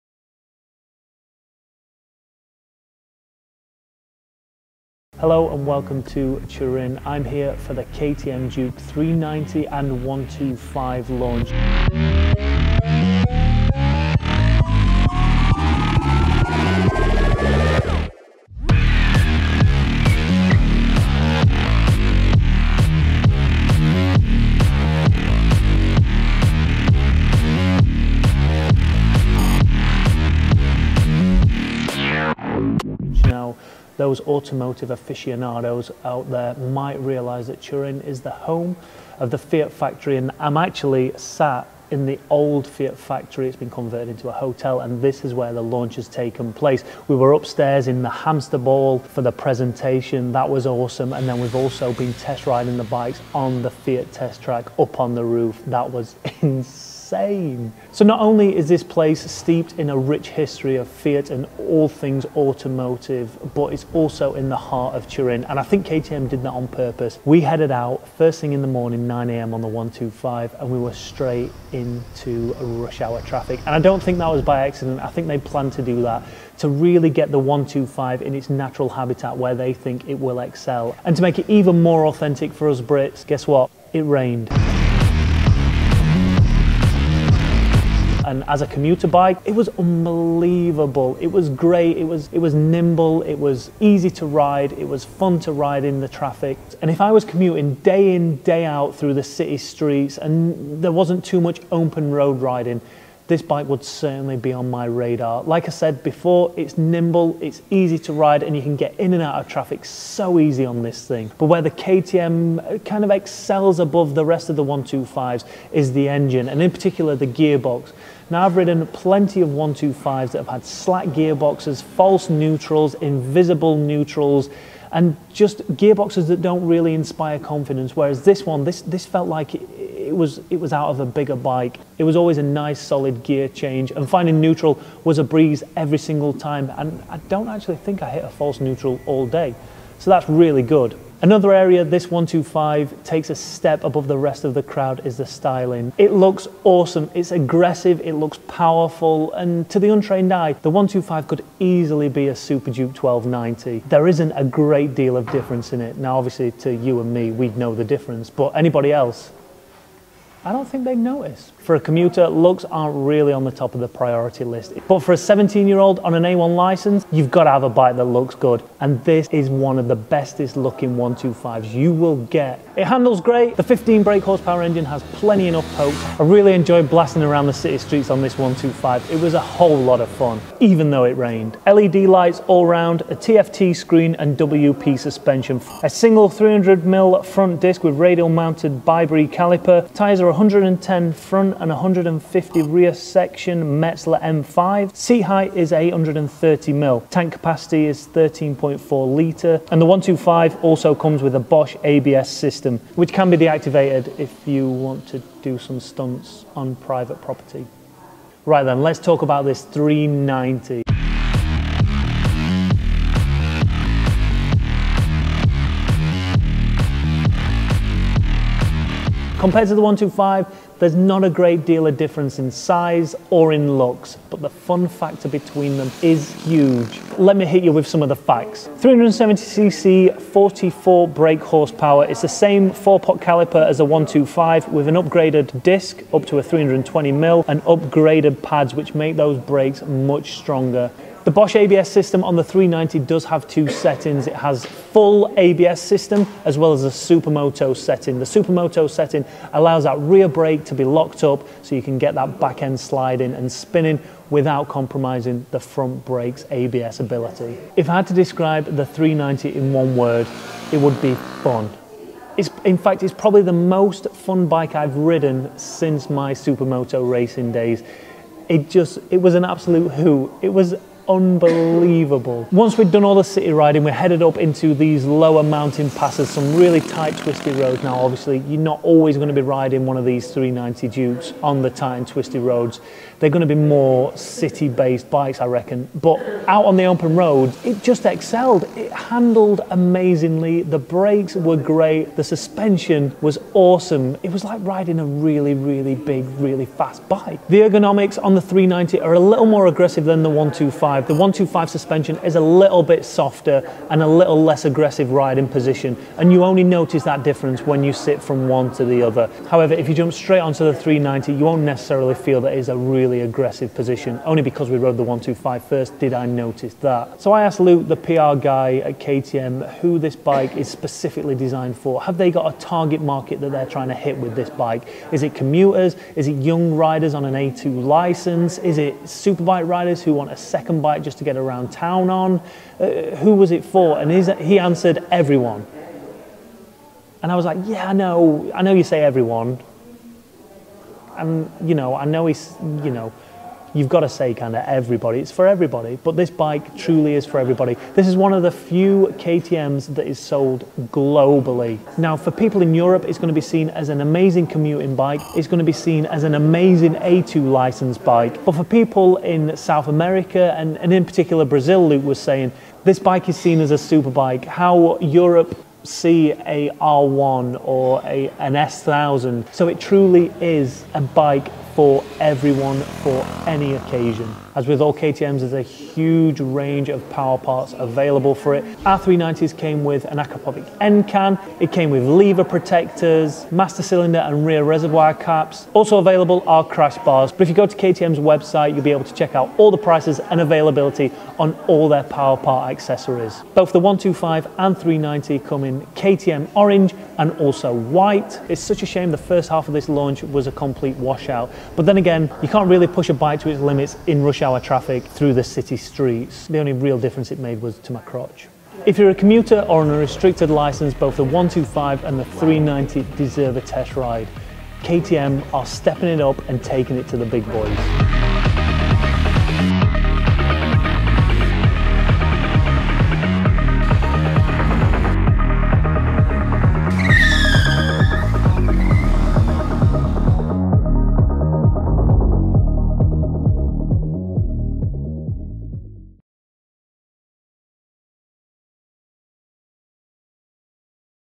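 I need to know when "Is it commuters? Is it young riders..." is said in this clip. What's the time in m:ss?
5:25.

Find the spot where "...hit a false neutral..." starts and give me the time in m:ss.
2:18.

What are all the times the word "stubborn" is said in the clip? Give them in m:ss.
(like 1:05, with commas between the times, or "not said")
not said.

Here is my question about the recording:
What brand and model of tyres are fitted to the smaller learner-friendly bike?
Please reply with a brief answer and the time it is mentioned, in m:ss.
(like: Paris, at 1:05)
Metzeler M5, at 3:13.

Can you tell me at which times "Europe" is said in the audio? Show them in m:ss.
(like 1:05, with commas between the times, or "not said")
5:52, 6:04.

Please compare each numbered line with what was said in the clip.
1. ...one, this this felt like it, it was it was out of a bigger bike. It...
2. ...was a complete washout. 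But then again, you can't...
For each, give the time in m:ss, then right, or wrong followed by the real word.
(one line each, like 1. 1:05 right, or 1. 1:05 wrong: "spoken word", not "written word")
1. 2:08 right
2. 6:40 right.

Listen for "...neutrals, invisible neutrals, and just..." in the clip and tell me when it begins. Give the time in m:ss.
2:02.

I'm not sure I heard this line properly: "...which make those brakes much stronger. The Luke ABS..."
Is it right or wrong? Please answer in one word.
wrong.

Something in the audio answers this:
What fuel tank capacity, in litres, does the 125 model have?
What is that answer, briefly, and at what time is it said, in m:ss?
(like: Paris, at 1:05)
13.4 litres, at 3:18.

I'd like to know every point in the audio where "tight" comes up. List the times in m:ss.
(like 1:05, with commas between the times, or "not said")
4:36, 4:41.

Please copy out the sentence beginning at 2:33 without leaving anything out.
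There isn't a great deal of difference in it.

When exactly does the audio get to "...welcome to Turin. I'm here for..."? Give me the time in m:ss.
0:05.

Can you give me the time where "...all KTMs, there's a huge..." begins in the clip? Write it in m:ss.
6:14.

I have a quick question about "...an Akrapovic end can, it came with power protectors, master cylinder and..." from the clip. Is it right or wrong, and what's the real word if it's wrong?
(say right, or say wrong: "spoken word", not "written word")
wrong: "lever", not "power".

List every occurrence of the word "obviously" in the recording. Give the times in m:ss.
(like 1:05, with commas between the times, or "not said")
2:36, 4:37.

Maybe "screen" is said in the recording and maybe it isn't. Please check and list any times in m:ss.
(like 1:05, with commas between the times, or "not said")
3:03.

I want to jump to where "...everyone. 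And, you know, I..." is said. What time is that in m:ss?
5:39.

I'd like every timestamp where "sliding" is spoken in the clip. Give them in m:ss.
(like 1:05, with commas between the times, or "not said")
4:12.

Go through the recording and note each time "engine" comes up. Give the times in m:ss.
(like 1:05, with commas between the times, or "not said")
1:56, 2:54.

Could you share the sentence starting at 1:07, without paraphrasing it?
We headed out first thing in the morning, 9 a.m.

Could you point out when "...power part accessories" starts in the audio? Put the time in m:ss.
6:32.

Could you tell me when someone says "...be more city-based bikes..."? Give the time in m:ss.
4:43.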